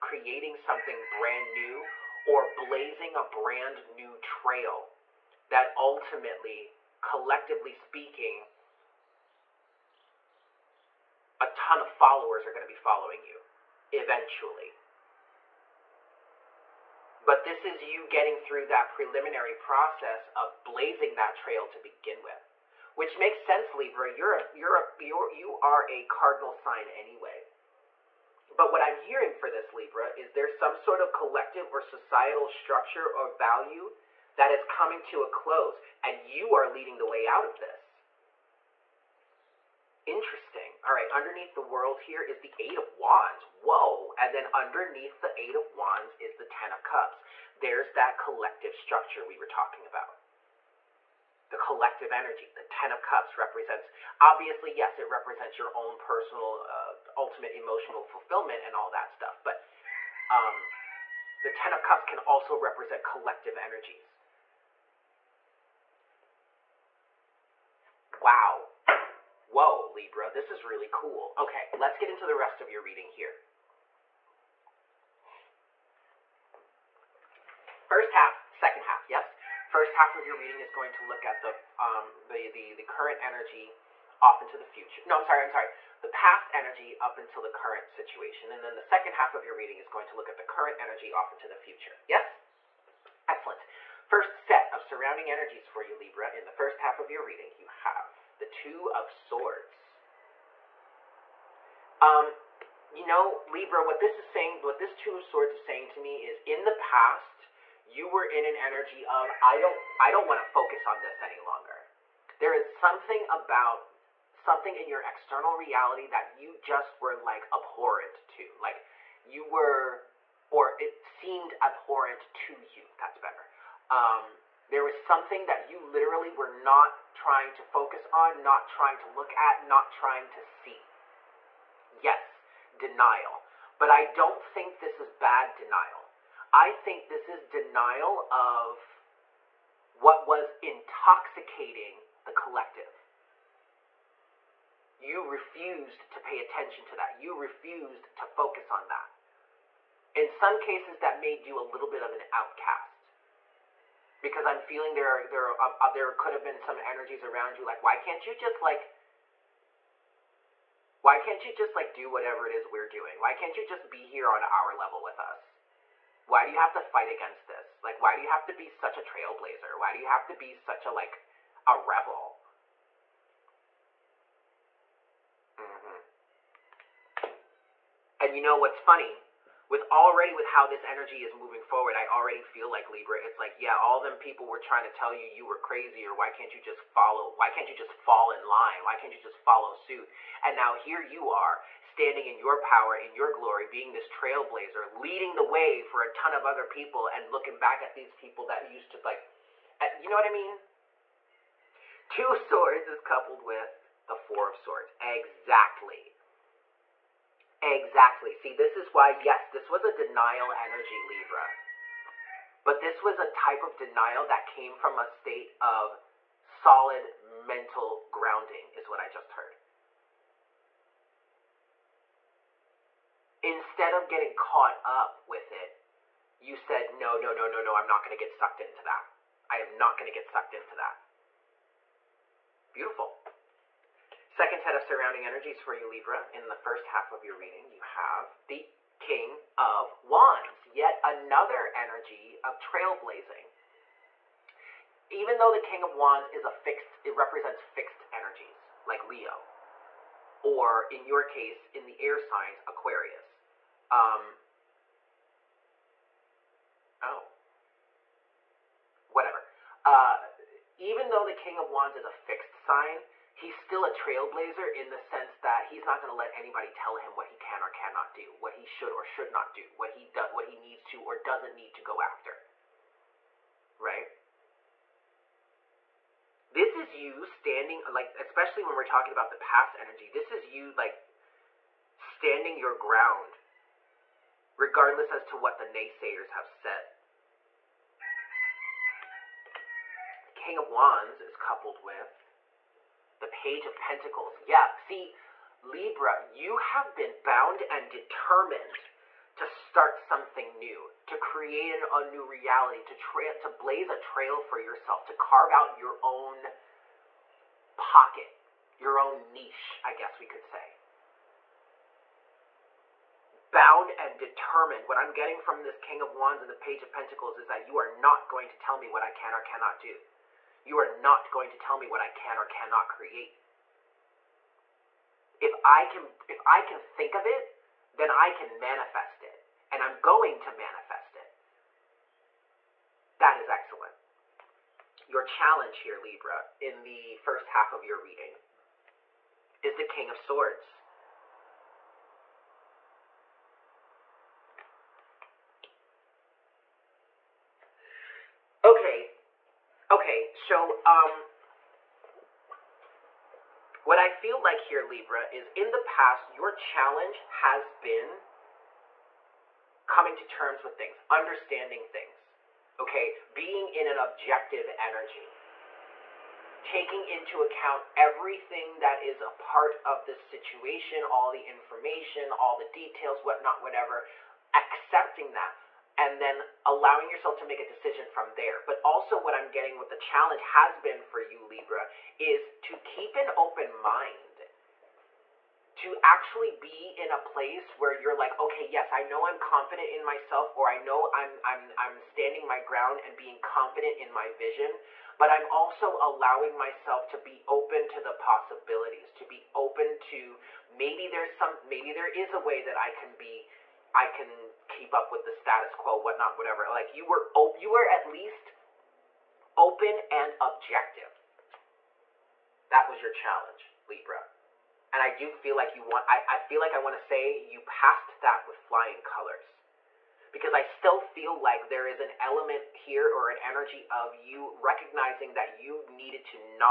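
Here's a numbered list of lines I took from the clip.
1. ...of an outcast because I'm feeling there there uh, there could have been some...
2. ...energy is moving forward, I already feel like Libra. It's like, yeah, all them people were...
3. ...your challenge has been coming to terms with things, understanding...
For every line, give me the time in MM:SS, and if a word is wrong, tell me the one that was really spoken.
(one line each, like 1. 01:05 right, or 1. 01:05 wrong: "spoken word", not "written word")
1. 02:32 right
2. 03:00 right
3. 05:56 right.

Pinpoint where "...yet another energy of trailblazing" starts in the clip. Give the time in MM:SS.
04:00.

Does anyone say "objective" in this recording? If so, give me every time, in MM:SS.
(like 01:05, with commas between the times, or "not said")
06:03, 06:50.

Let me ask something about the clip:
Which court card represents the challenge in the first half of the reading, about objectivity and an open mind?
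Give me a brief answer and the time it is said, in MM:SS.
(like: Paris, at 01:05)
King of Swords, at 05:39.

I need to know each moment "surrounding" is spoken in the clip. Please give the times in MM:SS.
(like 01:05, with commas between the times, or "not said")
01:34, 03:54.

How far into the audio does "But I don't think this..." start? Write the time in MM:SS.
02:13.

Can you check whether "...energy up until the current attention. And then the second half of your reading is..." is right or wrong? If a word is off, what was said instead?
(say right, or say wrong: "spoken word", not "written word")
wrong: "situation", not "attention".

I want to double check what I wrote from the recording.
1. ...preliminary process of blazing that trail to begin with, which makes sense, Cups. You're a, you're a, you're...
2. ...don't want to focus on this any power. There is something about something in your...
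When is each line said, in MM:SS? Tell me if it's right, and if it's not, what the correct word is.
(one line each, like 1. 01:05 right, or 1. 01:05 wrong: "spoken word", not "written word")
1. 00:18 wrong: "Libra", not "Cups"
2. 01:50 wrong: "longer", not "power".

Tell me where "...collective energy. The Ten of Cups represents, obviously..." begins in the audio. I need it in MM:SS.
00:51.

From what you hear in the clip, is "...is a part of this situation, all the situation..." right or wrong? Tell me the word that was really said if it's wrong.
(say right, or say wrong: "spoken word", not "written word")
wrong: "information", not "situation".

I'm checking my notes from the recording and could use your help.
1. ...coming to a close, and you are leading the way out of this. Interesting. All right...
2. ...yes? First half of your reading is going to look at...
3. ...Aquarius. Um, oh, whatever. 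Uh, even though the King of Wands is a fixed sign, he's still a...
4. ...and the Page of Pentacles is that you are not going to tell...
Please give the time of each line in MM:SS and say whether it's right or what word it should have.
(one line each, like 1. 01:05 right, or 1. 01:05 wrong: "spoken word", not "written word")
1. 00:34 right
2. 01:19 right
3. 04:12 right
4. 05:16 right.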